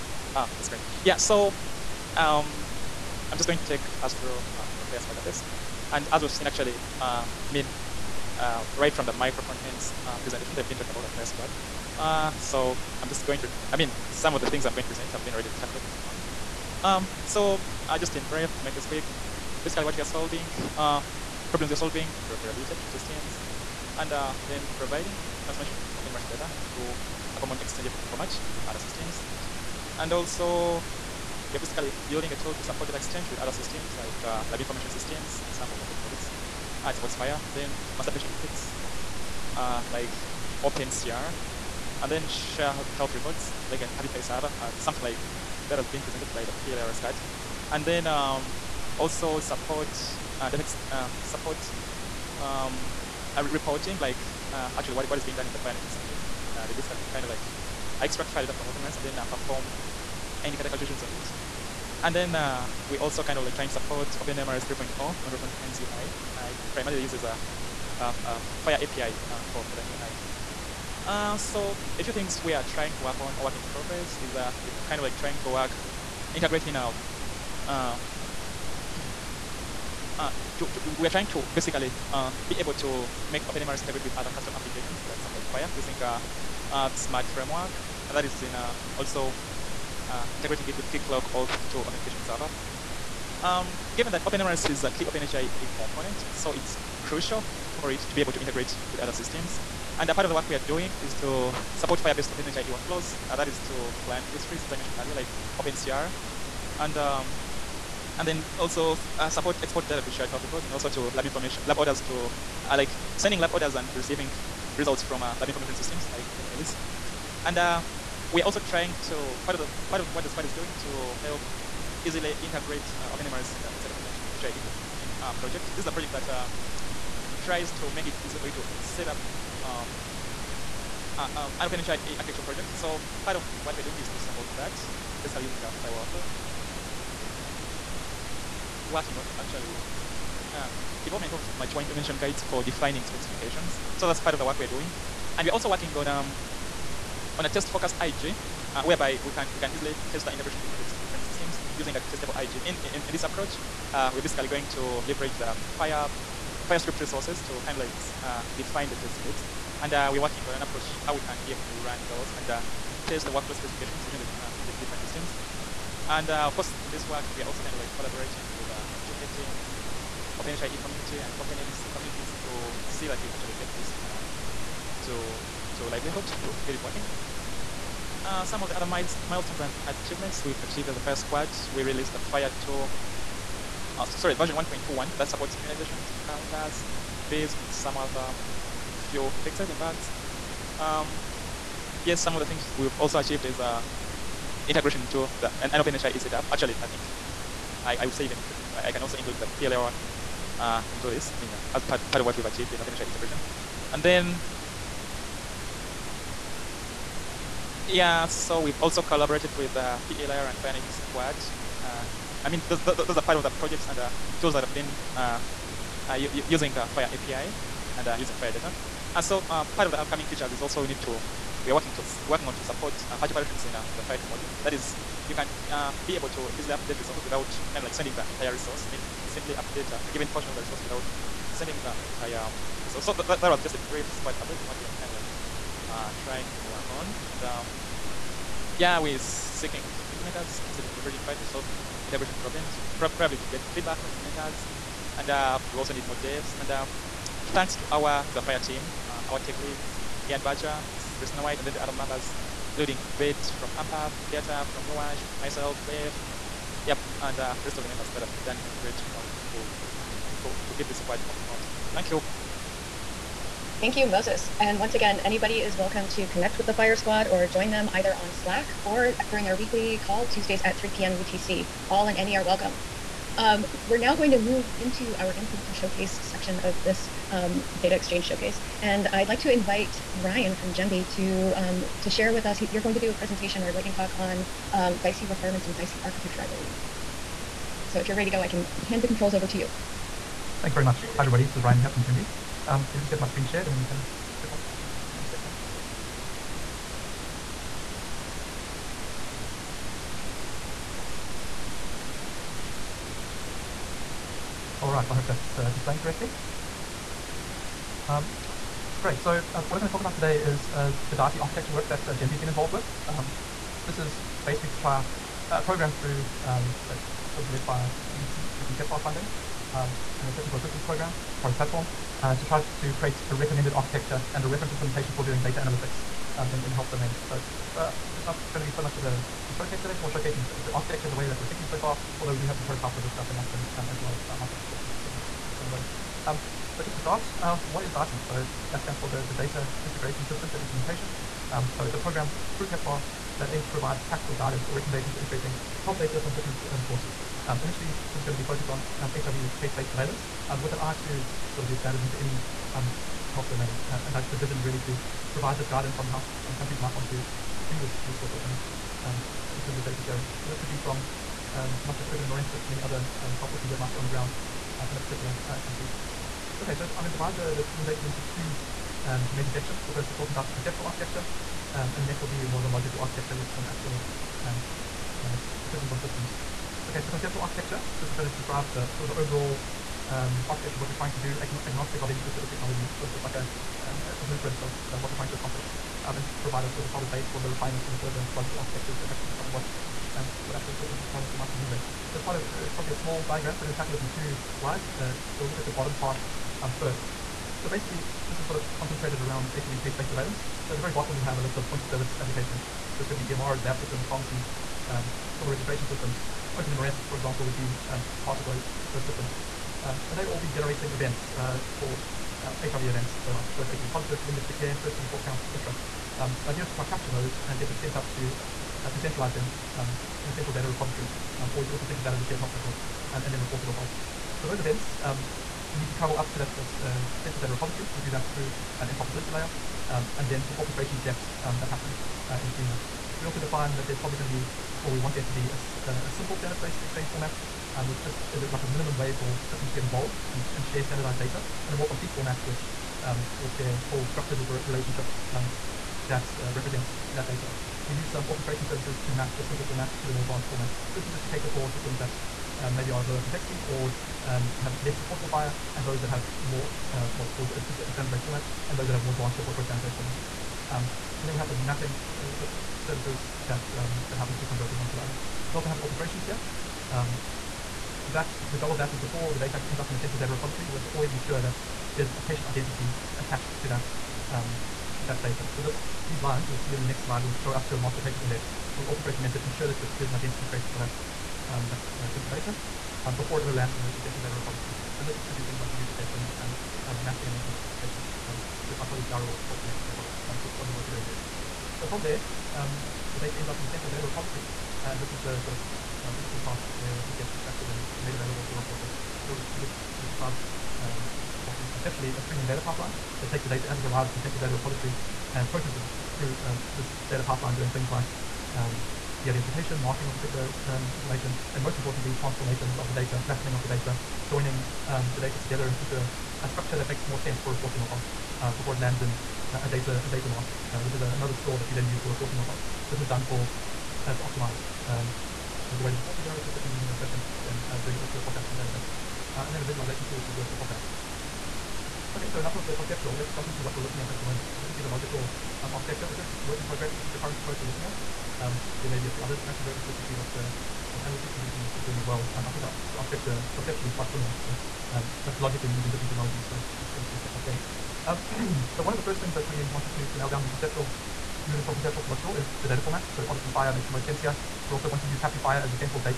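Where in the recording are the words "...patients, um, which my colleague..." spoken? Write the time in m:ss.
8:07.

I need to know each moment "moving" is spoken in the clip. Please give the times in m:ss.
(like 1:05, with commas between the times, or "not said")
4:21, 9:11.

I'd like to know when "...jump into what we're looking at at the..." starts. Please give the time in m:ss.
8:53.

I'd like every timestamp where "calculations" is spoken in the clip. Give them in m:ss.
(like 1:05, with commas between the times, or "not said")
1:00.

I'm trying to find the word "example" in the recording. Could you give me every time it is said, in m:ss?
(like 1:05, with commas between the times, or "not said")
0:35, 6:47.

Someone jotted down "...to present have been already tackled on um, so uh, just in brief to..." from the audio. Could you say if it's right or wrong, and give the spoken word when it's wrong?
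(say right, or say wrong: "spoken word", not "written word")
right.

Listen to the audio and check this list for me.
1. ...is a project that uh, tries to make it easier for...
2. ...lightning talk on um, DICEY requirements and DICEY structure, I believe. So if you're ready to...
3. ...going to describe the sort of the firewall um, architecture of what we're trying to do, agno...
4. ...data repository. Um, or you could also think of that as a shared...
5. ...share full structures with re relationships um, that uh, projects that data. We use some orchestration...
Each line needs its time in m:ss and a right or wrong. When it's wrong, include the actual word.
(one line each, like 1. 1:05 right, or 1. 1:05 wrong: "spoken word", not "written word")
1. 2:05 right
2. 4:43 wrong: "architecture", not "structure"
3. 6:18 wrong: "overall", not "firewall"
4. 7:00 right
5. 7:23 wrong: "represents", not "projects".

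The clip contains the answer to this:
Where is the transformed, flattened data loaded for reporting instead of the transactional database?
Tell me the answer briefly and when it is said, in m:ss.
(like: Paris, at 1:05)
data mart, at 8:40.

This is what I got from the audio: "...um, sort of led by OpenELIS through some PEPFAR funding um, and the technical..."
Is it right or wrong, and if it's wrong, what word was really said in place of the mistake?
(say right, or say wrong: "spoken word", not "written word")
wrong: "CDC", not "OpenELIS".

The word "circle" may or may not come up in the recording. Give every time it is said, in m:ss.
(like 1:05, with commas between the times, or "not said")
not said.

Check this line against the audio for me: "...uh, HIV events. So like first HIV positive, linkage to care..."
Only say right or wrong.
right.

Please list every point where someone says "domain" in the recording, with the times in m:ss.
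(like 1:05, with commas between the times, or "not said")
5:26, 5:53.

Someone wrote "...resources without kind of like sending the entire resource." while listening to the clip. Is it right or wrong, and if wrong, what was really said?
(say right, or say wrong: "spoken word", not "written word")
right.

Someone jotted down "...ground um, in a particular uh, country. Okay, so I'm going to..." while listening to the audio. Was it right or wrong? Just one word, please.
right.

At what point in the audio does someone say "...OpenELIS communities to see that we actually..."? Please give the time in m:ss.
2:51.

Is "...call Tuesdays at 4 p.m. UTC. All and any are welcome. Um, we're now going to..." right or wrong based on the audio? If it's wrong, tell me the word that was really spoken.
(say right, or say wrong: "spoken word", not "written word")
wrong: "3", not "4".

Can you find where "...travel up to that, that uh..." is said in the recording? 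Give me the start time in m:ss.
7:05.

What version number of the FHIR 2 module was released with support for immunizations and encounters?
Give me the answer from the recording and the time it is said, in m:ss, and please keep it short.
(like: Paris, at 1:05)
1.21, at 3:04.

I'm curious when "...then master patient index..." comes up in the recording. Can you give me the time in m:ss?
0:37.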